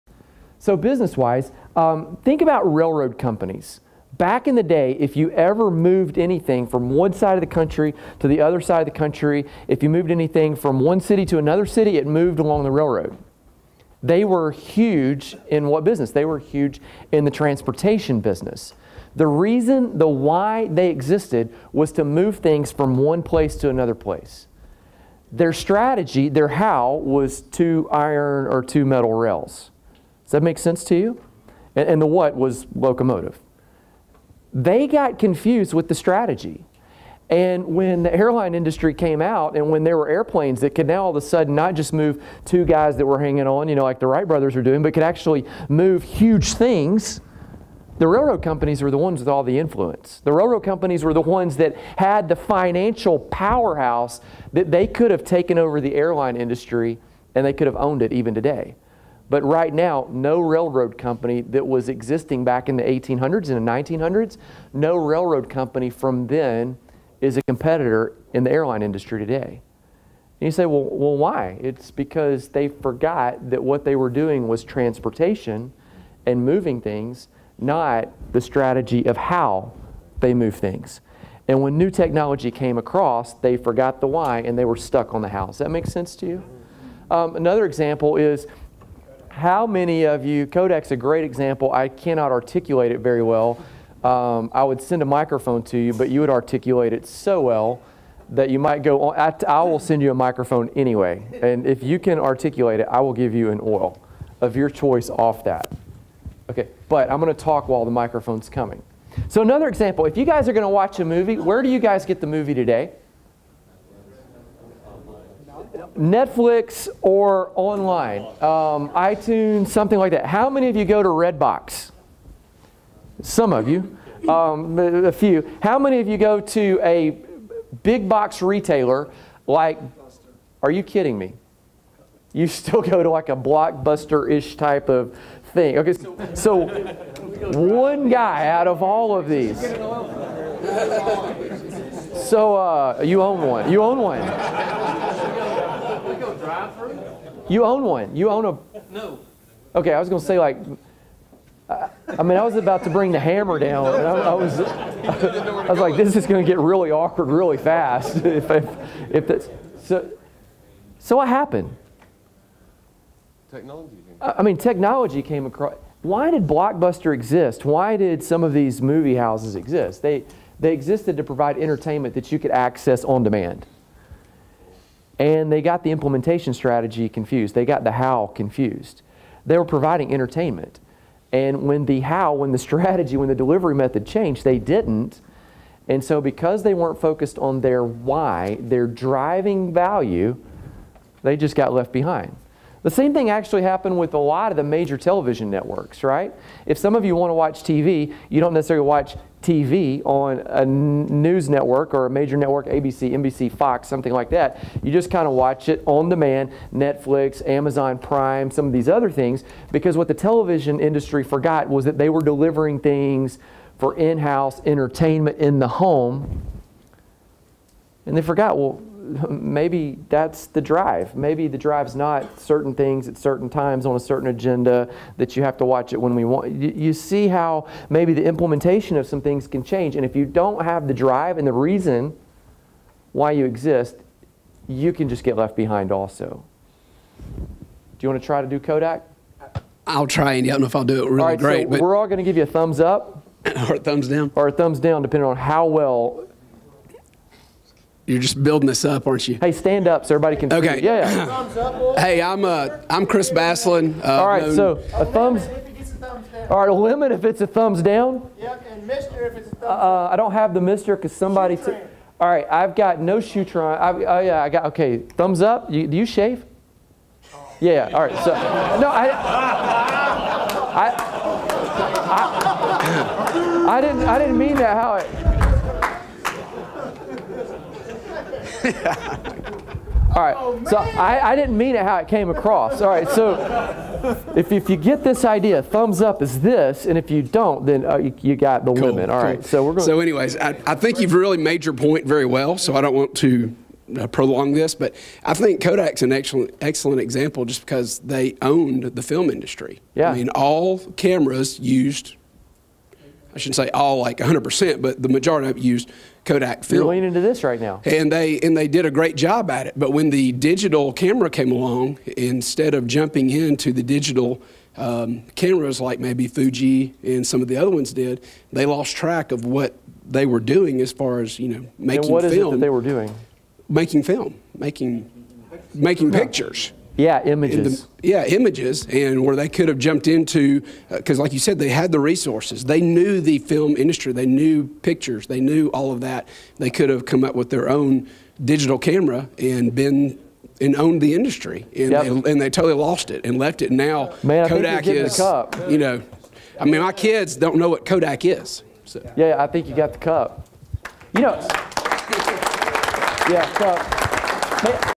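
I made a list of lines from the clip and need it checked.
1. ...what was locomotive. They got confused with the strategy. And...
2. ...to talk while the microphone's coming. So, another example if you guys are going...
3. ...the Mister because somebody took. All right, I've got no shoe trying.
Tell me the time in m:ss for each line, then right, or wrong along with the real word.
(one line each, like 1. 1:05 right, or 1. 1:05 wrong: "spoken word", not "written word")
1. 0:32 right
2. 1:47 right
3. 4:20 right.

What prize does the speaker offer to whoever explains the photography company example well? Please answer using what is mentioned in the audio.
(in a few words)
an oil of your choice.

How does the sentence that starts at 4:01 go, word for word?
So we're all going to give you a thumbs up.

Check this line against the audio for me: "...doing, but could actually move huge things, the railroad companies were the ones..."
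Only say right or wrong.
right.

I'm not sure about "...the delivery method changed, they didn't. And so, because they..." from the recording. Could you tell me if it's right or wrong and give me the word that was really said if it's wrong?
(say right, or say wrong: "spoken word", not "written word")
right.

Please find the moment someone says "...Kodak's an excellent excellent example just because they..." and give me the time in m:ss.
4:55.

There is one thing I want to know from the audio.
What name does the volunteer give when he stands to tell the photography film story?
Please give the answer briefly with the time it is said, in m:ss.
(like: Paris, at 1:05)
Chris Baslin, at 4:13.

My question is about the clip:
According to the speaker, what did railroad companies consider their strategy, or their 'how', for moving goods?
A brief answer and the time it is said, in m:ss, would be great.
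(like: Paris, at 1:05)
two metal rails, at 0:28.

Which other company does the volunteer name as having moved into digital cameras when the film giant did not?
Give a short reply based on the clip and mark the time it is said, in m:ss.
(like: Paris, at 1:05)
Fuji, at 5:16.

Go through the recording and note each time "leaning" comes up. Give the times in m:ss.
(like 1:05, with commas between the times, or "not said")
5:06.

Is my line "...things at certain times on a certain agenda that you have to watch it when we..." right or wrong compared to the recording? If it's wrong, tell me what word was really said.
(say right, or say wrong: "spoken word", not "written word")
right.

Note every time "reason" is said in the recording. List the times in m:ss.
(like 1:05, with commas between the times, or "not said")
0:19, 3:51.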